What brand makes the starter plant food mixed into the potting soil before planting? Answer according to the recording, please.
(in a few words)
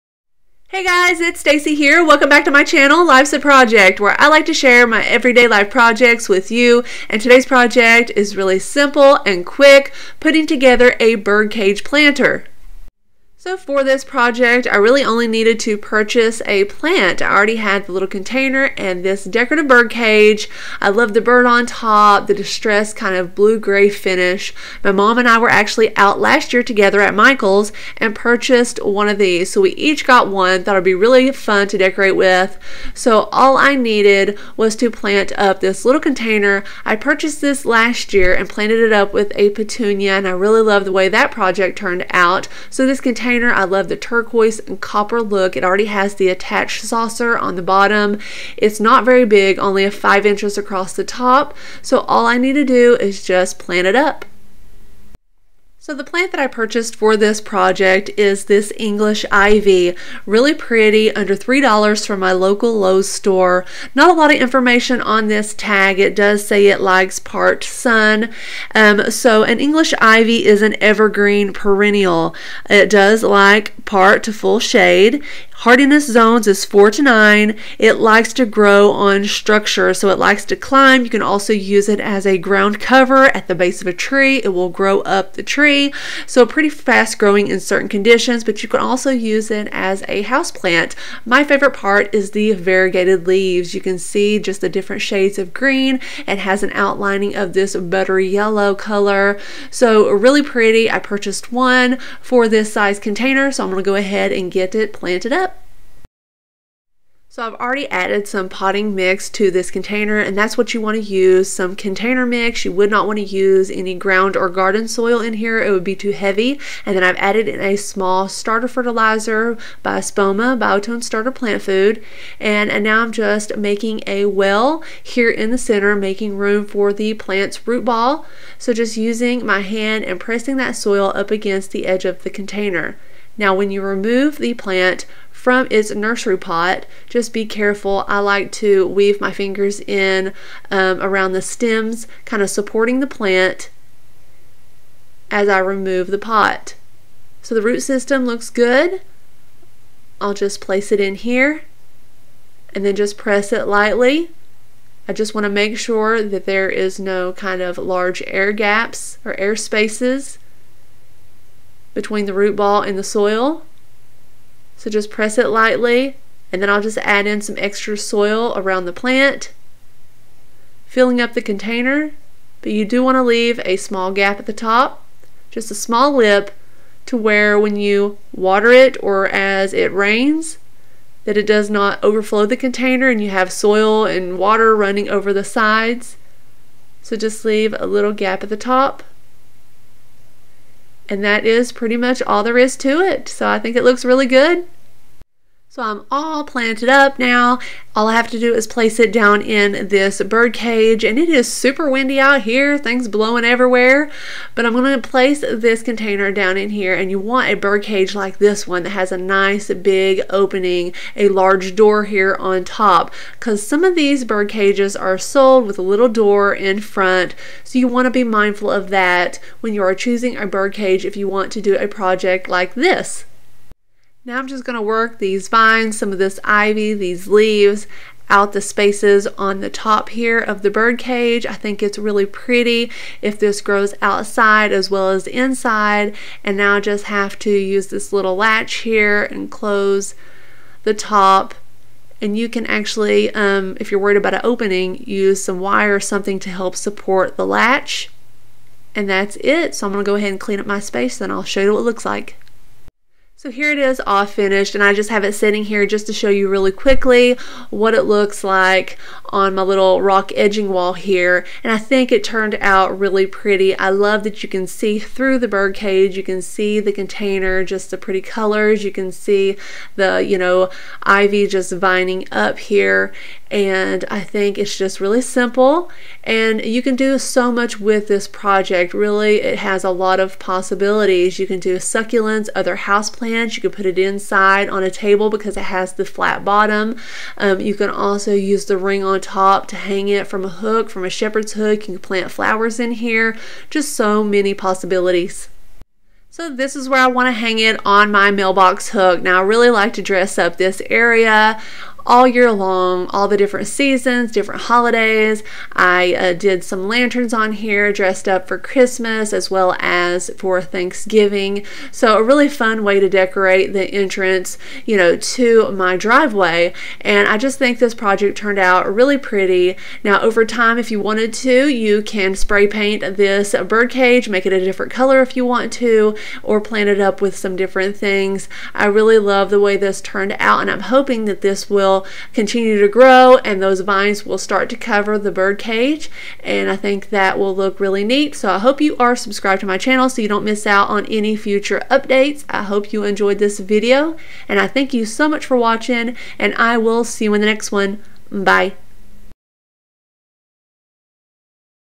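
Espoma.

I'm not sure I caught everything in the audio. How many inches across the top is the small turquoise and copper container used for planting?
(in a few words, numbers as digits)
5.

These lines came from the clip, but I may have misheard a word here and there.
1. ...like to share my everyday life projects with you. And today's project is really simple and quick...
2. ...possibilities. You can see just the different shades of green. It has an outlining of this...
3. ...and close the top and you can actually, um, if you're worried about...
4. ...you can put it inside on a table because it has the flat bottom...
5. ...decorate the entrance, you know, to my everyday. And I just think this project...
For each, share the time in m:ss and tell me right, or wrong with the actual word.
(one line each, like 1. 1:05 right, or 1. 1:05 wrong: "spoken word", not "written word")
1. 0:04 right
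2. 1:33 wrong: "leaves", not "possibilities"
3. 3:59 right
4. 4:43 right
5. 5:13 wrong: "driveway", not "everyday".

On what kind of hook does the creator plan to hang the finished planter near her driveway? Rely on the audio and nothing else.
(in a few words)
mailbox hook.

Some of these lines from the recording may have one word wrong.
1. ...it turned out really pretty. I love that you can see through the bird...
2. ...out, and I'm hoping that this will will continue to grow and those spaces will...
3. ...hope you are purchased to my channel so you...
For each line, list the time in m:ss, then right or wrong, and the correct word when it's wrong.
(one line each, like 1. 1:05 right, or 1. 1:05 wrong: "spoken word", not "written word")
1. 4:22 right
2. 5:30 wrong: "vines", not "spaces"
3. 5:38 wrong: "subscribed", not "purchased".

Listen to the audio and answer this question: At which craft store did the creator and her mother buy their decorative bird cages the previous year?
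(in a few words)
Michael's.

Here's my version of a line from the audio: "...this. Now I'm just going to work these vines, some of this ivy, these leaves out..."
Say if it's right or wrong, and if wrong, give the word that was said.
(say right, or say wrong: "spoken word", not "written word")
right.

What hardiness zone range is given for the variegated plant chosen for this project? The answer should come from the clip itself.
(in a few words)
4 to 9.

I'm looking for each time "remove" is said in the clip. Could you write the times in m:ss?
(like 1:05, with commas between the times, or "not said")
2:13, 2:25.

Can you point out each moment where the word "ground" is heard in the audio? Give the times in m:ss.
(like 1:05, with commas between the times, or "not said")
1:22, 1:53.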